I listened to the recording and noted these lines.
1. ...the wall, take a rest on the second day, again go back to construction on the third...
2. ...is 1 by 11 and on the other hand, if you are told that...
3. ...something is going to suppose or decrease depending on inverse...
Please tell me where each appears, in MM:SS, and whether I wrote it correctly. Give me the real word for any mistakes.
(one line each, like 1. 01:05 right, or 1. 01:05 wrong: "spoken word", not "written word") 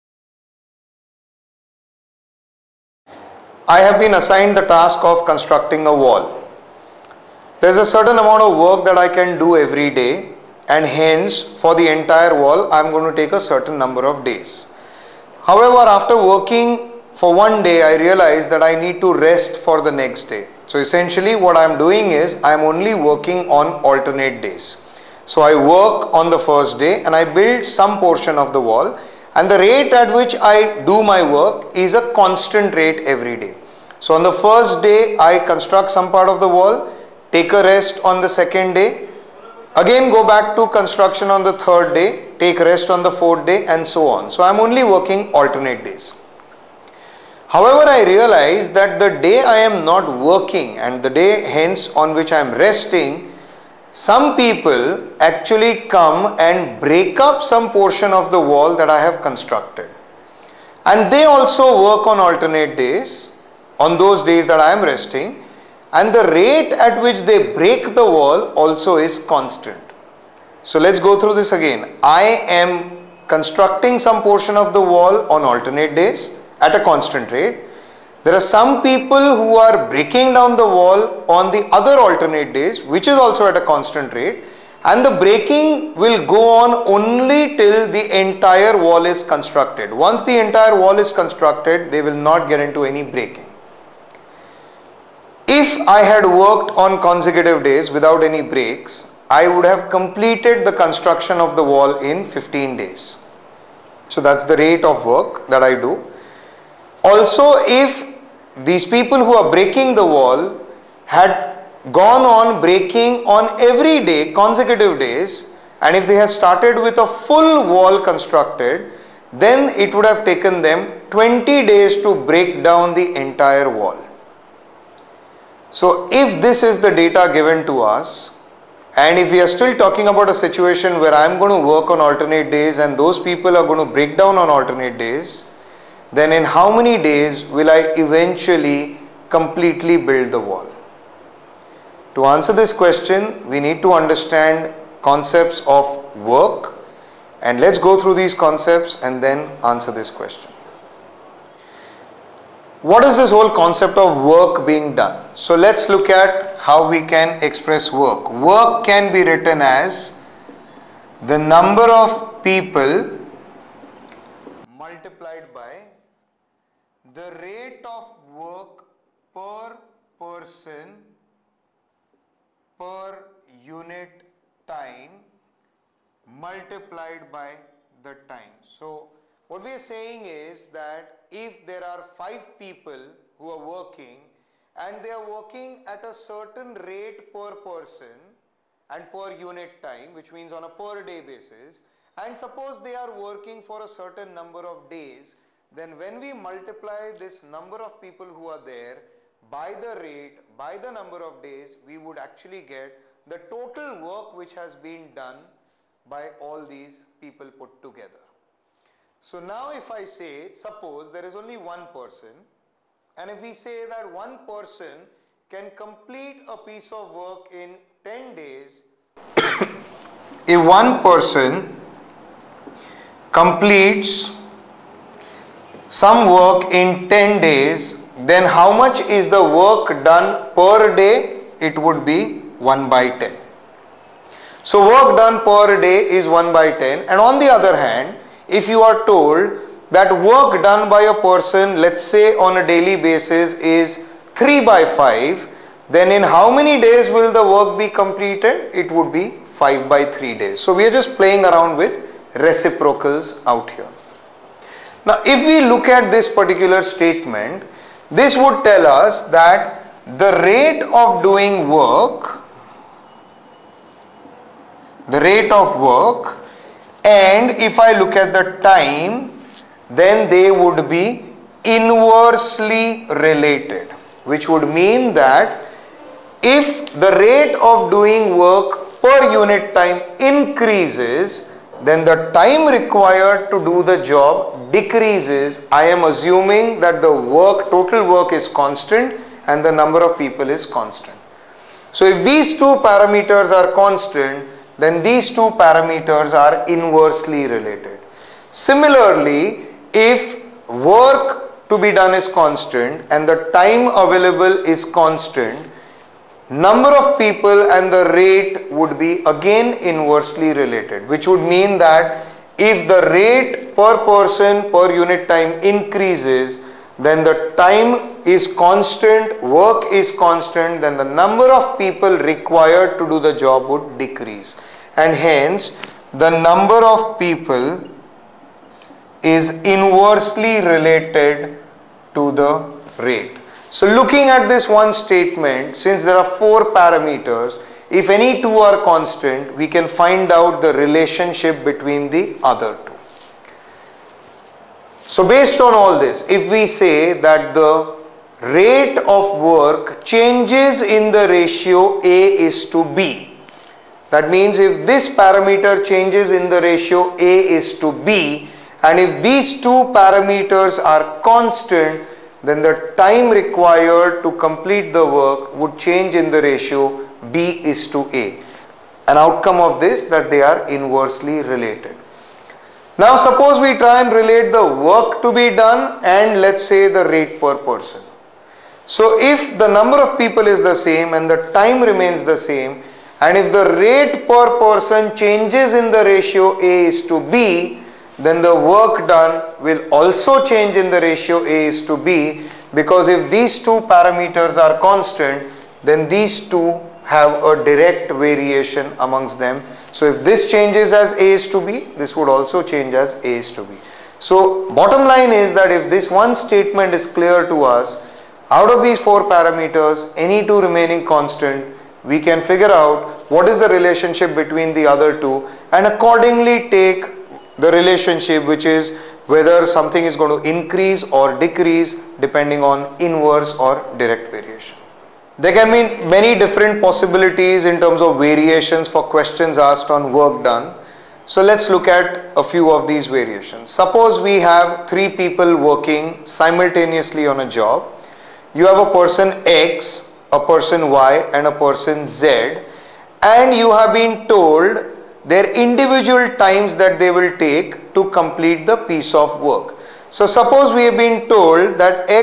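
1. 00:36 right
2. 03:56 wrong: "10", not "11"
3. 06:59 wrong: "increase", not "suppose".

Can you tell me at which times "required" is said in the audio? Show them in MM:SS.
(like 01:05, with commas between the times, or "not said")
04:42, 05:22, 06:03.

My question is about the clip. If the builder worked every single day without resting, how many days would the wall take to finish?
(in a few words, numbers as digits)
15.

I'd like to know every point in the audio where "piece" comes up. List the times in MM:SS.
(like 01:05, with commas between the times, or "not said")
03:36, 07:28.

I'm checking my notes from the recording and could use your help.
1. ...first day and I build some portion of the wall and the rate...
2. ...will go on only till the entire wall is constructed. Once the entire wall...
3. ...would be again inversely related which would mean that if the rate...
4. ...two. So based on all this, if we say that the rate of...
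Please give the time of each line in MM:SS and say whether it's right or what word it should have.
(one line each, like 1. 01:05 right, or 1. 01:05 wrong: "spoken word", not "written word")
1. 00:26 right
2. 01:25 right
3. 05:08 right
4. 05:42 right.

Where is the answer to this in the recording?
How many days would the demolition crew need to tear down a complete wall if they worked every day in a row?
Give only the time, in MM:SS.
02:01.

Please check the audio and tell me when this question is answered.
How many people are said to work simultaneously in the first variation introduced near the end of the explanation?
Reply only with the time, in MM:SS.
07:14.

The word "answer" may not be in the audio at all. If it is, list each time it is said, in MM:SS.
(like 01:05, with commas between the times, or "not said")
02:22, 02:29.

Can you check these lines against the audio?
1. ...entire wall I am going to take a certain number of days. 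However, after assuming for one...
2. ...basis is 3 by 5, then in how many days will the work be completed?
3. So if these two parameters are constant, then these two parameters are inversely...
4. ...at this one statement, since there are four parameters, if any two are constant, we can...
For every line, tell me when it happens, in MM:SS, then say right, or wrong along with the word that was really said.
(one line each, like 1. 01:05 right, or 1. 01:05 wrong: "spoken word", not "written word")
1. 00:11 wrong: "working", not "assuming"
2. 04:03 right
3. 04:51 right
4. 05:34 right.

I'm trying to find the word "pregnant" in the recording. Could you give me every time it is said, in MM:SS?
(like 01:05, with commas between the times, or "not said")
not said.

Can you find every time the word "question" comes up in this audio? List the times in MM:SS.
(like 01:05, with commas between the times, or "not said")
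02:22, 02:30, 07:09.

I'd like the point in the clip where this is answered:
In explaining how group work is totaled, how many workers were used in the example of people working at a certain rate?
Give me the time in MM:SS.
03:02.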